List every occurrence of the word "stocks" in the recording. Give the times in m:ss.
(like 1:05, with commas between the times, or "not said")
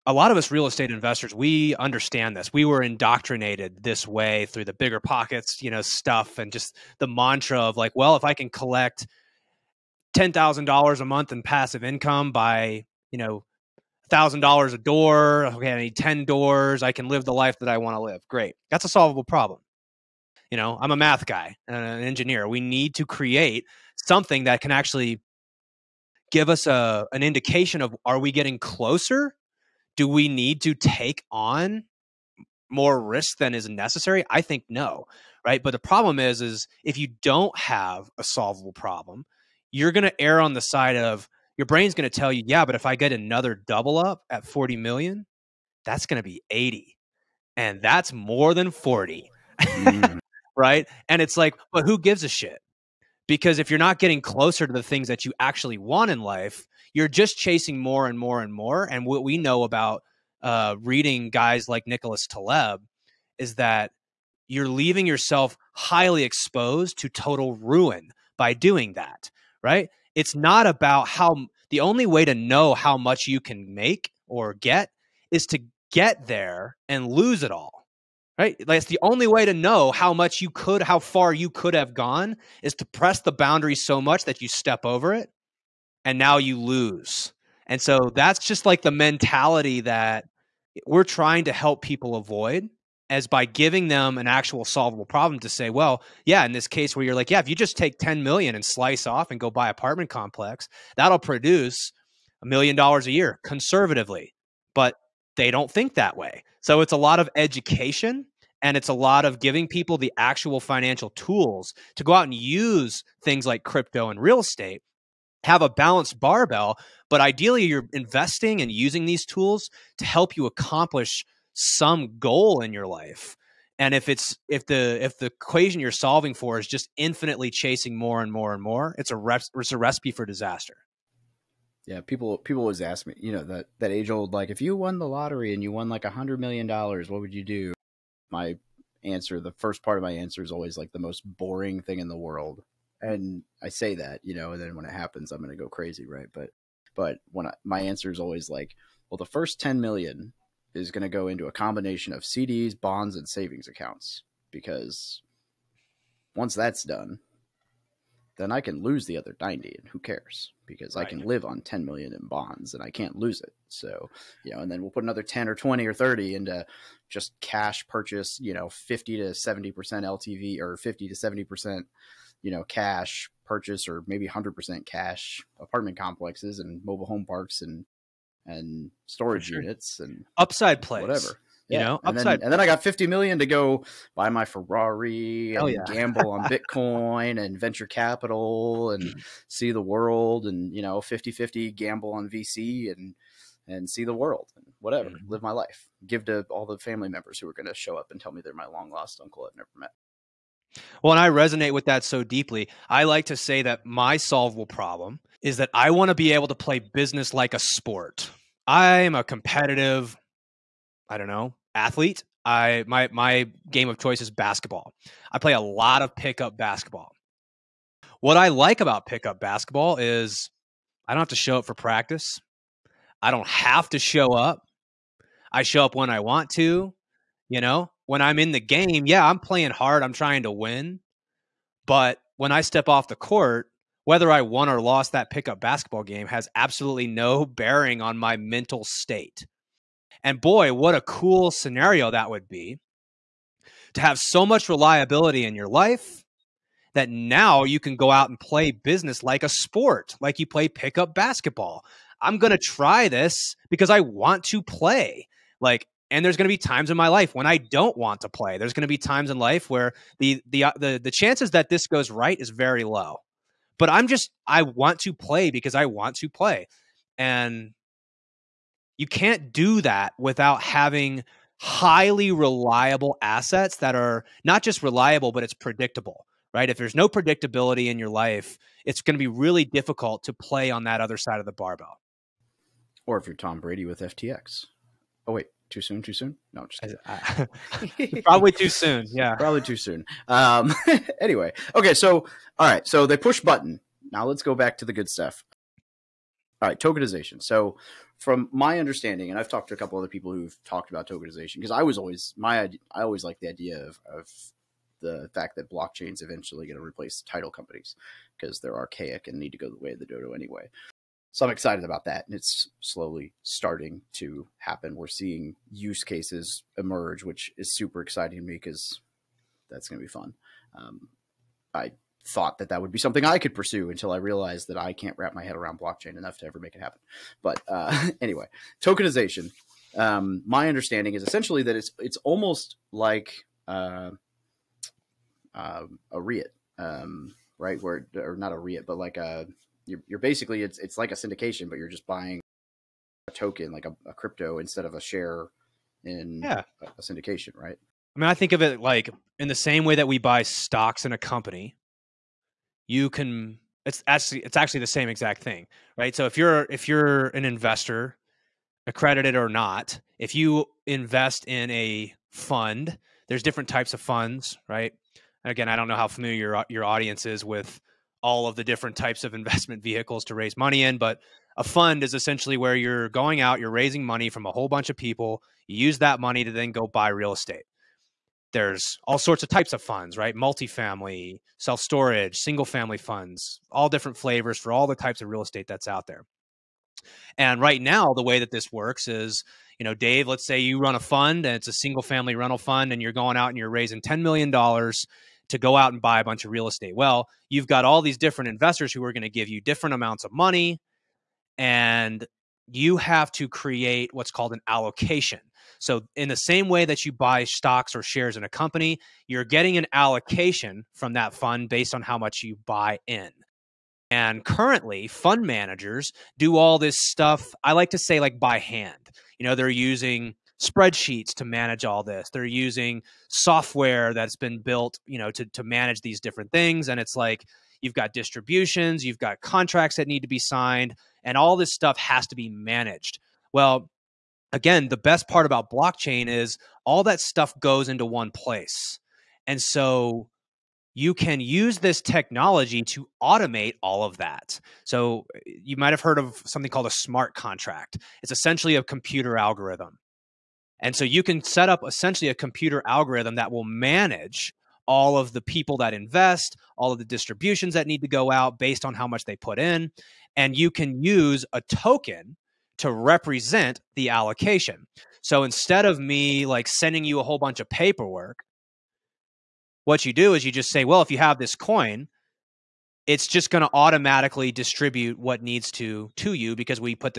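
5:50, 6:47.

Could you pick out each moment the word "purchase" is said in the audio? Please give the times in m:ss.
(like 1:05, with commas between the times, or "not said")
2:47, 2:53.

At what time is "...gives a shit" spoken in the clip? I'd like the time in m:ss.
0:51.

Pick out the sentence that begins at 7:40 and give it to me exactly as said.
And you can use a token to represent the allocation.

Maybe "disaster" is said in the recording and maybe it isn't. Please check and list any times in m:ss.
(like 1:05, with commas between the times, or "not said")
2:10.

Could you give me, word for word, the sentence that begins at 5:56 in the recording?
So if you're if you're an investor, accredited or not, if you invest in a fund, there's different types of funds, right?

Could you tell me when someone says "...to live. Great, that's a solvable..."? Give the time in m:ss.
0:17.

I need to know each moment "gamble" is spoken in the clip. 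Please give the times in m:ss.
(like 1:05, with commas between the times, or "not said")
3:05, 3:11.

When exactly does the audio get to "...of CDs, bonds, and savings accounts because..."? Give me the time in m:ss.
2:32.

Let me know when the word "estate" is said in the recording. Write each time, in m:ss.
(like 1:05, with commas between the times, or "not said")
0:00, 1:54, 6:17, 6:25, 6:36.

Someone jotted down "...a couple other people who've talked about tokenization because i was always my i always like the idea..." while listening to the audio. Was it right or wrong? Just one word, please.
right.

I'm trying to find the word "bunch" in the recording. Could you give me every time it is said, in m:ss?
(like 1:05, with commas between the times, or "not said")
6:14, 6:36, 7:47.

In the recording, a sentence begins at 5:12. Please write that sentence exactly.
And it's slowly starting to happen.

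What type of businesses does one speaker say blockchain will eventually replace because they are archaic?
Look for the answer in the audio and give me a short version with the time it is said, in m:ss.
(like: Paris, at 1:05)
Title companies, at 5:07.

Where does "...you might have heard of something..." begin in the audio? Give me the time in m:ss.
7:25.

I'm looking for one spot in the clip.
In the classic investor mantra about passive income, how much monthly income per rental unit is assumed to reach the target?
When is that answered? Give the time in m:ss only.
0:14.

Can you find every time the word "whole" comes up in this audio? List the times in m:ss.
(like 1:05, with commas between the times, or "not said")
6:14, 7:47.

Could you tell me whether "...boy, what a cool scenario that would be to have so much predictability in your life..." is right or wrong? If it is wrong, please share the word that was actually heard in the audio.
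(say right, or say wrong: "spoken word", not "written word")
wrong: "reliability", not "predictability".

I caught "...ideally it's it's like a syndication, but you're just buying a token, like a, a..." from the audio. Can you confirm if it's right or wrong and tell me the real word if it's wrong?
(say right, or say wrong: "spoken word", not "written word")
wrong: "basically", not "ideally".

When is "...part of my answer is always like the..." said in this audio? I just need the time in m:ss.
2:19.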